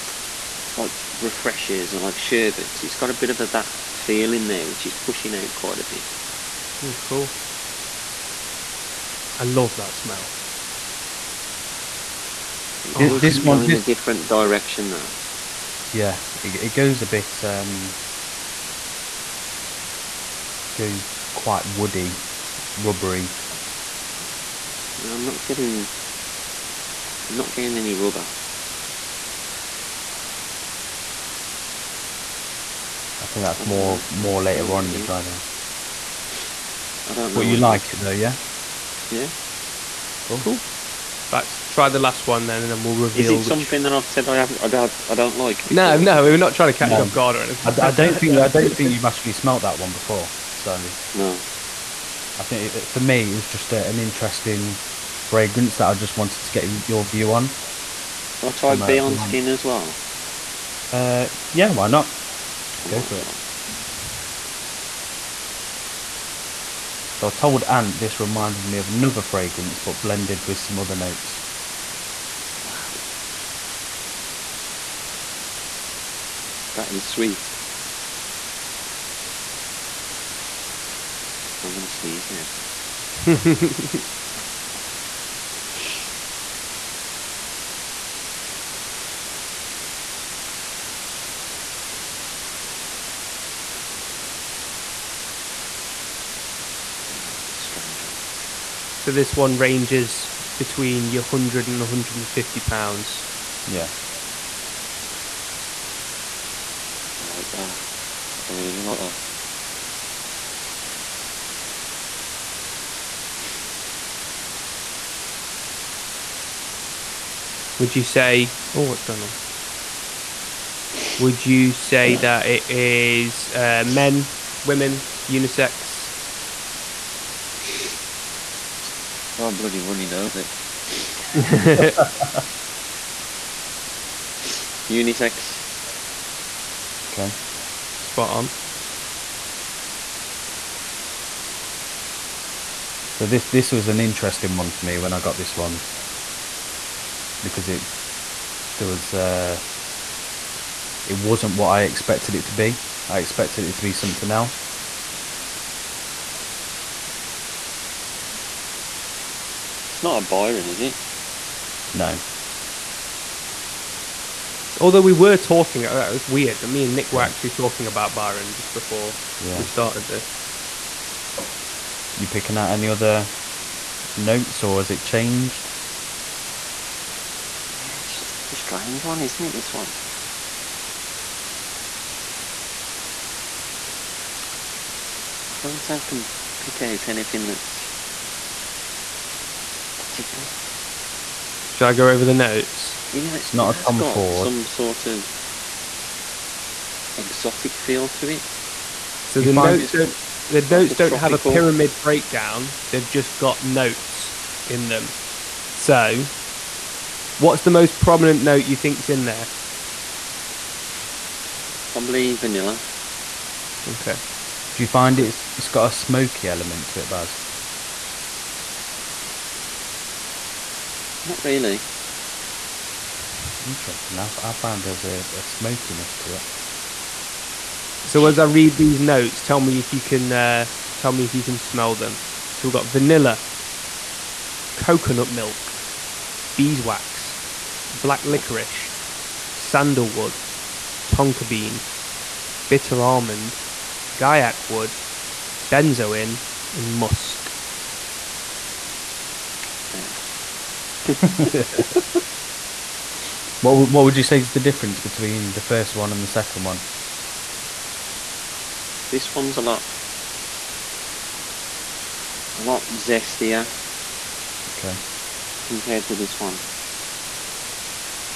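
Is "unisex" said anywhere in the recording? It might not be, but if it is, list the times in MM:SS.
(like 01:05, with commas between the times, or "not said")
02:05, 02:14.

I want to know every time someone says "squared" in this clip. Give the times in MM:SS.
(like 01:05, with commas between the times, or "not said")
not said.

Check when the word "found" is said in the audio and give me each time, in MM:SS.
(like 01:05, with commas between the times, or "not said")
03:44.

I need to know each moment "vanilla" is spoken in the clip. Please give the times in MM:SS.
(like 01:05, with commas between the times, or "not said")
03:32, 03:52.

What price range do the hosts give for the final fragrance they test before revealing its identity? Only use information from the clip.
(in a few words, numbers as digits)
100 to 150 pounds.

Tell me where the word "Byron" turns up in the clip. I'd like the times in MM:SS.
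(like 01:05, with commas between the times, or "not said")
02:40, 02:48.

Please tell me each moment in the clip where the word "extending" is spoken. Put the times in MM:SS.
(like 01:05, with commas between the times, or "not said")
not said.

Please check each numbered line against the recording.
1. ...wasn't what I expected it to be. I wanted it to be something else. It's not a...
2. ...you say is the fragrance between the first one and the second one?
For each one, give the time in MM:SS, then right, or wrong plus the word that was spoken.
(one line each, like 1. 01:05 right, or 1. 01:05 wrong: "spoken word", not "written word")
1. 02:31 wrong: "expected", not "wanted"
2. 04:14 wrong: "difference", not "fragrance".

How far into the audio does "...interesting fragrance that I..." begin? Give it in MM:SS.
00:53.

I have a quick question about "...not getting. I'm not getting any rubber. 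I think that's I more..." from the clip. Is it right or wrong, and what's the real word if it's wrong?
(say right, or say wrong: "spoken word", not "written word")
right.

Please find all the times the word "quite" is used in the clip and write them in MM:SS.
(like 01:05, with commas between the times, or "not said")
00:05, 00:21.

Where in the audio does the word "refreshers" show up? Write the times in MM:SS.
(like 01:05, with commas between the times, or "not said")
00:01.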